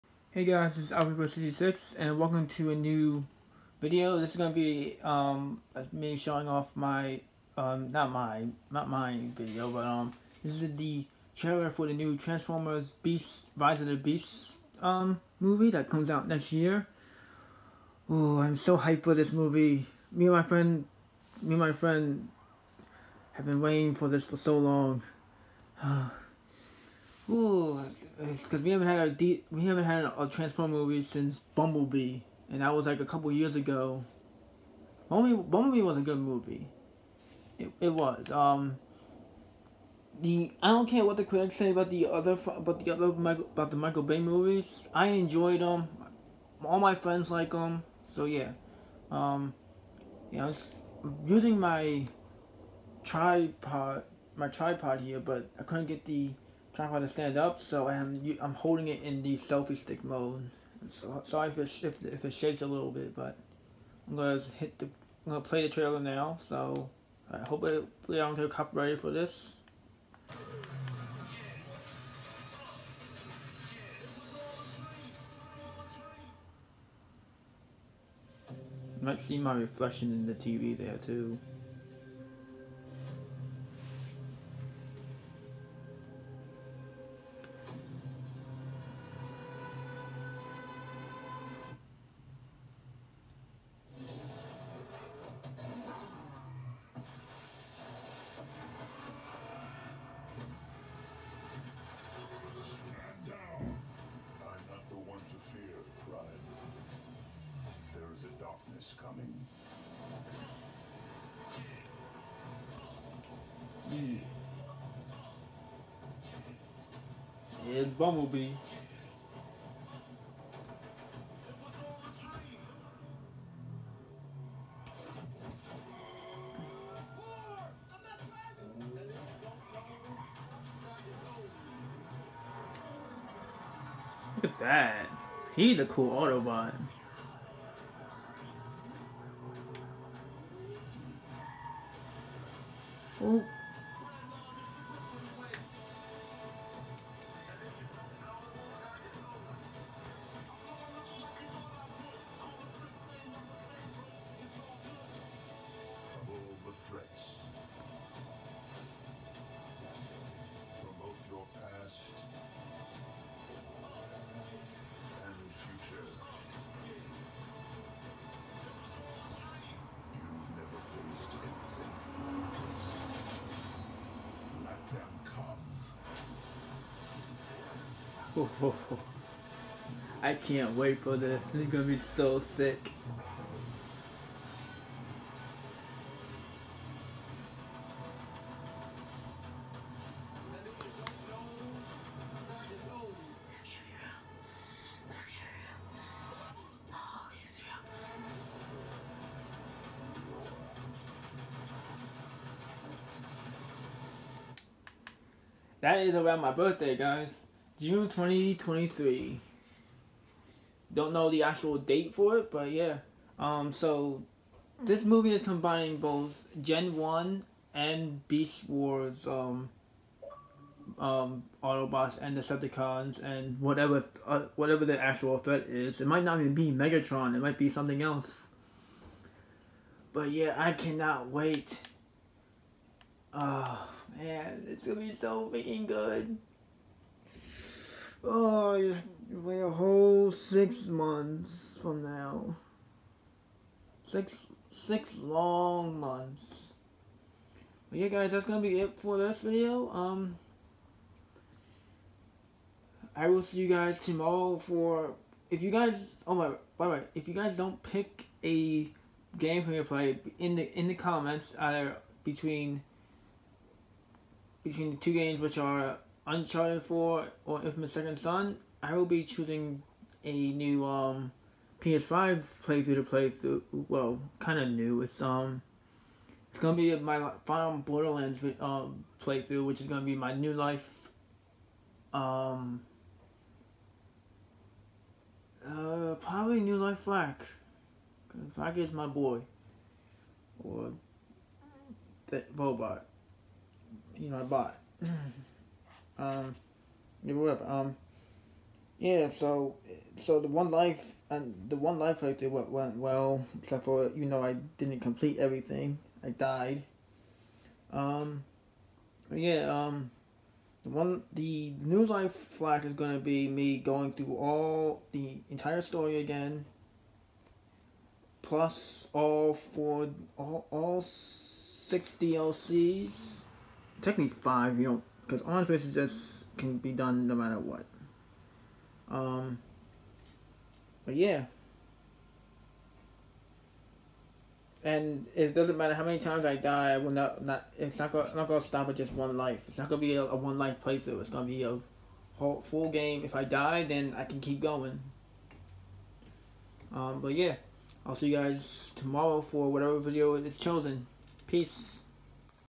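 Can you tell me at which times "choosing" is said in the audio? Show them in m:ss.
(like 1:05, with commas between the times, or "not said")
4:29.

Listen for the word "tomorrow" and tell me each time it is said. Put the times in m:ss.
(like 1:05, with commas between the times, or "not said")
4:13, 5:48.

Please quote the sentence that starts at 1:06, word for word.
So I hope I don't get copyrighted for this.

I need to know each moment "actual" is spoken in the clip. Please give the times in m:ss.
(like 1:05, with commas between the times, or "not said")
3:31, 3:45.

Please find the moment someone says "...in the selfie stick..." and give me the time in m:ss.
0:59.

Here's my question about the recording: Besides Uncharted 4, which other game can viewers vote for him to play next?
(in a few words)
Infamous Second Son.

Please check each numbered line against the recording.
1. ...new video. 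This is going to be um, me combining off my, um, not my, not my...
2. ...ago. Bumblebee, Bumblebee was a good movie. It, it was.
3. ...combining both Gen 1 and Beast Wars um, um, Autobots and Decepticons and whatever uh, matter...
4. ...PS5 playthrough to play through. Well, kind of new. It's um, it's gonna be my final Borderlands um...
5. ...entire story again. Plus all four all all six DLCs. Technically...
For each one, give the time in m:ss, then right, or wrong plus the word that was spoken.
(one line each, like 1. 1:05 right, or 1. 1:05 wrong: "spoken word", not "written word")
1. 0:02 wrong: "showing", not "combining"
2. 0:33 right
3. 3:35 wrong: "whatever", not "matter"
4. 4:31 right
5. 5:15 right.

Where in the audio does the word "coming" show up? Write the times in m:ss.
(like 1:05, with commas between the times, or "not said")
1:49.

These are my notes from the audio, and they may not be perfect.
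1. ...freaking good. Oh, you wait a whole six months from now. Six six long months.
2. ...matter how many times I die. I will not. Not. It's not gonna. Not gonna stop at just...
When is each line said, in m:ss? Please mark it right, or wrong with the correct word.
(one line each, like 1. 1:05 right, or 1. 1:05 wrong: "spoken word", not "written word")
1. 3:55 right
2. 5:35 right.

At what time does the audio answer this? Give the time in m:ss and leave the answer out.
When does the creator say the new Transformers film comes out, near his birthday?
3:27.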